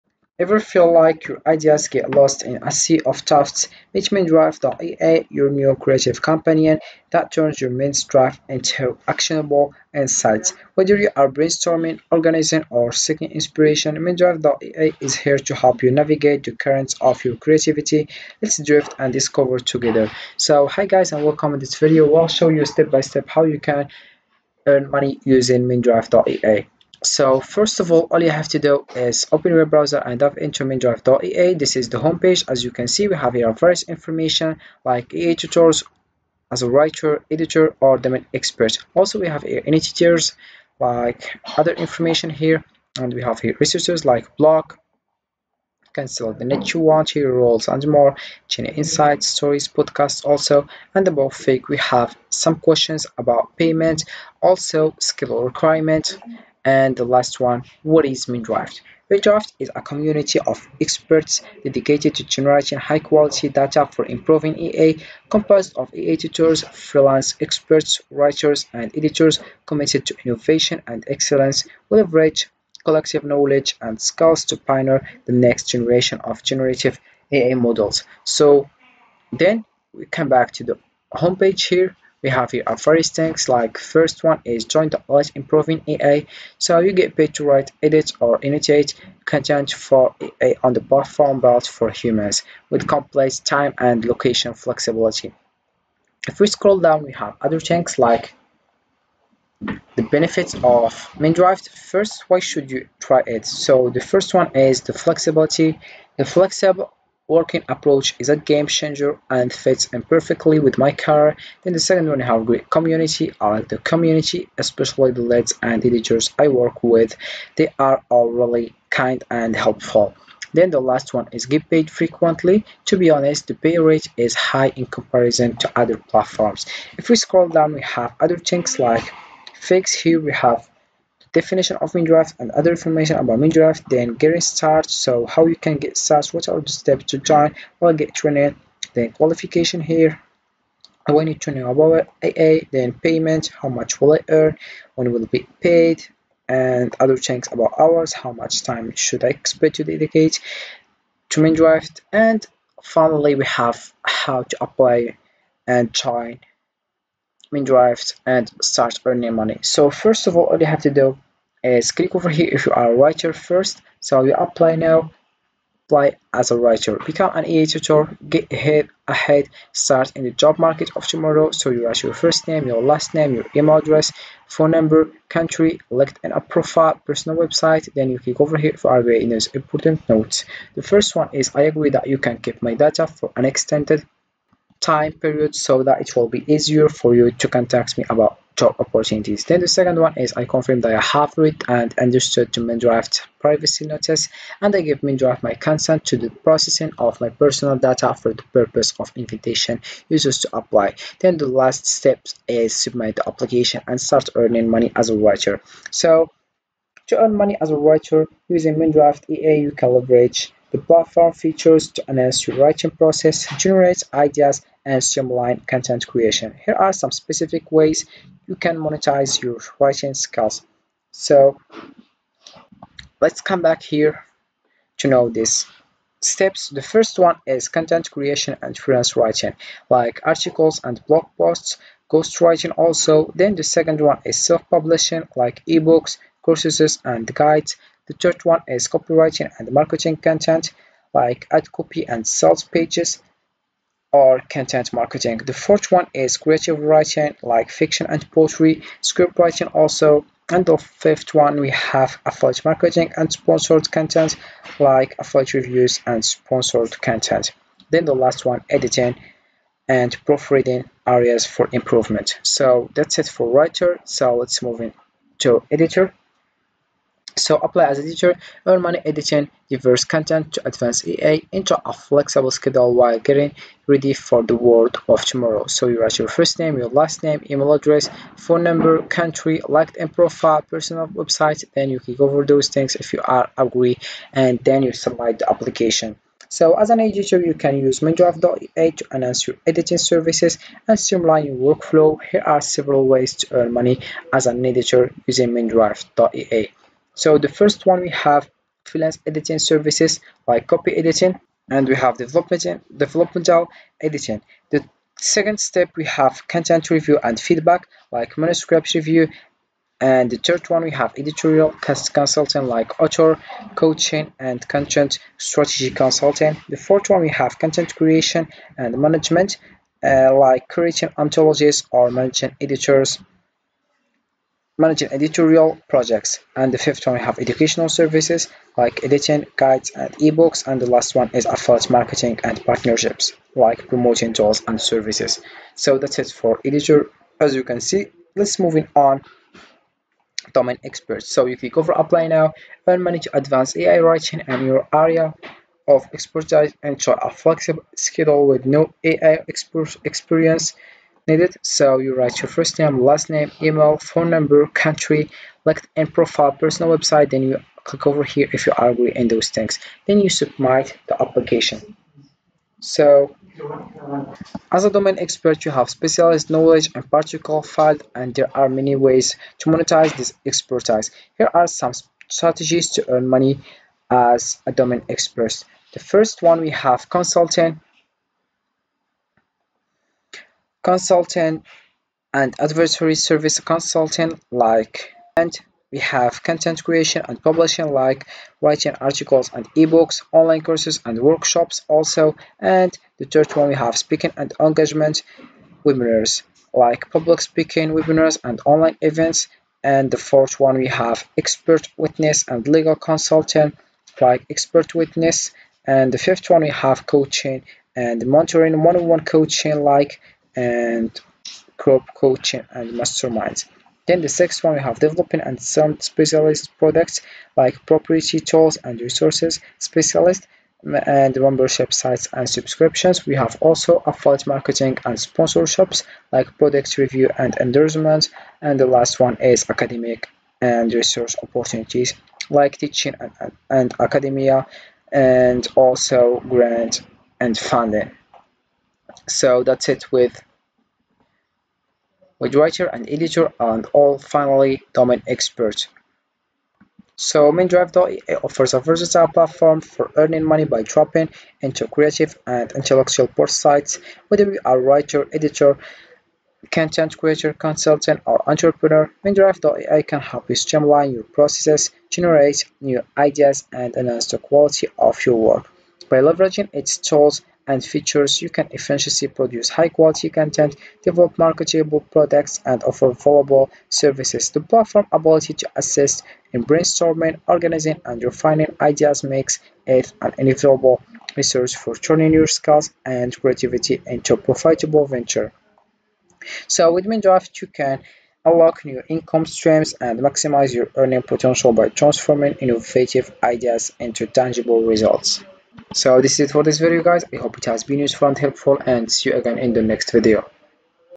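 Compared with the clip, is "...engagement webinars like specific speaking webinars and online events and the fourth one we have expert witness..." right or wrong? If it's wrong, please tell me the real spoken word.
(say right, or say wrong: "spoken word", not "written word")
wrong: "public", not "specific".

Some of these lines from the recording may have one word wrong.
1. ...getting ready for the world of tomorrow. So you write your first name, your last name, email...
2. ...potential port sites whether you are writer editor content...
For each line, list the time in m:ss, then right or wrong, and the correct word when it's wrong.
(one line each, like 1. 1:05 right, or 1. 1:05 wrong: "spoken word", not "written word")
1. 4:33 right
2. 7:32 wrong: "intellectual", not "potential".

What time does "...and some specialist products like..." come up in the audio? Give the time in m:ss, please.
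6:55.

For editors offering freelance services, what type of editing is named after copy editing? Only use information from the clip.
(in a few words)
Developmental editing.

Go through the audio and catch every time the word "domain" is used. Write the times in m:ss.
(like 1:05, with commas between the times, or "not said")
0:37, 5:40, 6:04, 6:14, 7:24.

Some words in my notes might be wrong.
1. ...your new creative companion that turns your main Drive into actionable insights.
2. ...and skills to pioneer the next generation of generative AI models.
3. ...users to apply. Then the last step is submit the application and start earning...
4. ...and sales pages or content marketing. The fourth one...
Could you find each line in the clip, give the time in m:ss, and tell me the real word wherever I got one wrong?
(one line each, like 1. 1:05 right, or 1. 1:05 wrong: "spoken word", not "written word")
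1. 0:05 right
2. 1:13 right
3. 3:20 right
4. 4:02 right.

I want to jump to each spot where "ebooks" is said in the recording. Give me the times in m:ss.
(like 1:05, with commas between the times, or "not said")
3:55, 5:30, 6:29.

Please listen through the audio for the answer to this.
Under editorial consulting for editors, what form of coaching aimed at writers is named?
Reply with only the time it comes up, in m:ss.
5:12.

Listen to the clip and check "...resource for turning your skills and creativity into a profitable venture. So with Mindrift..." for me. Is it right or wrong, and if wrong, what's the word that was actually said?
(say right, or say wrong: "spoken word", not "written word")
right.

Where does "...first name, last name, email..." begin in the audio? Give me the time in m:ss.
5:52.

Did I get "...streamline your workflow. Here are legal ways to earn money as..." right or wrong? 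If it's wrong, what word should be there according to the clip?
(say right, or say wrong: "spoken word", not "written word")
wrong: "several", not "legal".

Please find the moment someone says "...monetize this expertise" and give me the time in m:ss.
6:09.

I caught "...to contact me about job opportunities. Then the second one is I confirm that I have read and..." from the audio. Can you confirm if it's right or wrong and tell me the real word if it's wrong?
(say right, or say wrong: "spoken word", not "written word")
right.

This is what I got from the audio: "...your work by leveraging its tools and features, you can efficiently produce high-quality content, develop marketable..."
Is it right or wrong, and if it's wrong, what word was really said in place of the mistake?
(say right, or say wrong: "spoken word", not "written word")
right.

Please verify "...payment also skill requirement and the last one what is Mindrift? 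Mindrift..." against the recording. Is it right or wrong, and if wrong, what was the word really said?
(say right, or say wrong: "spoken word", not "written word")
right.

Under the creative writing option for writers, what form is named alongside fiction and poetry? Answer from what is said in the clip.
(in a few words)
Script writing.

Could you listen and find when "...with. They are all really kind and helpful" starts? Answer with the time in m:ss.
1:56.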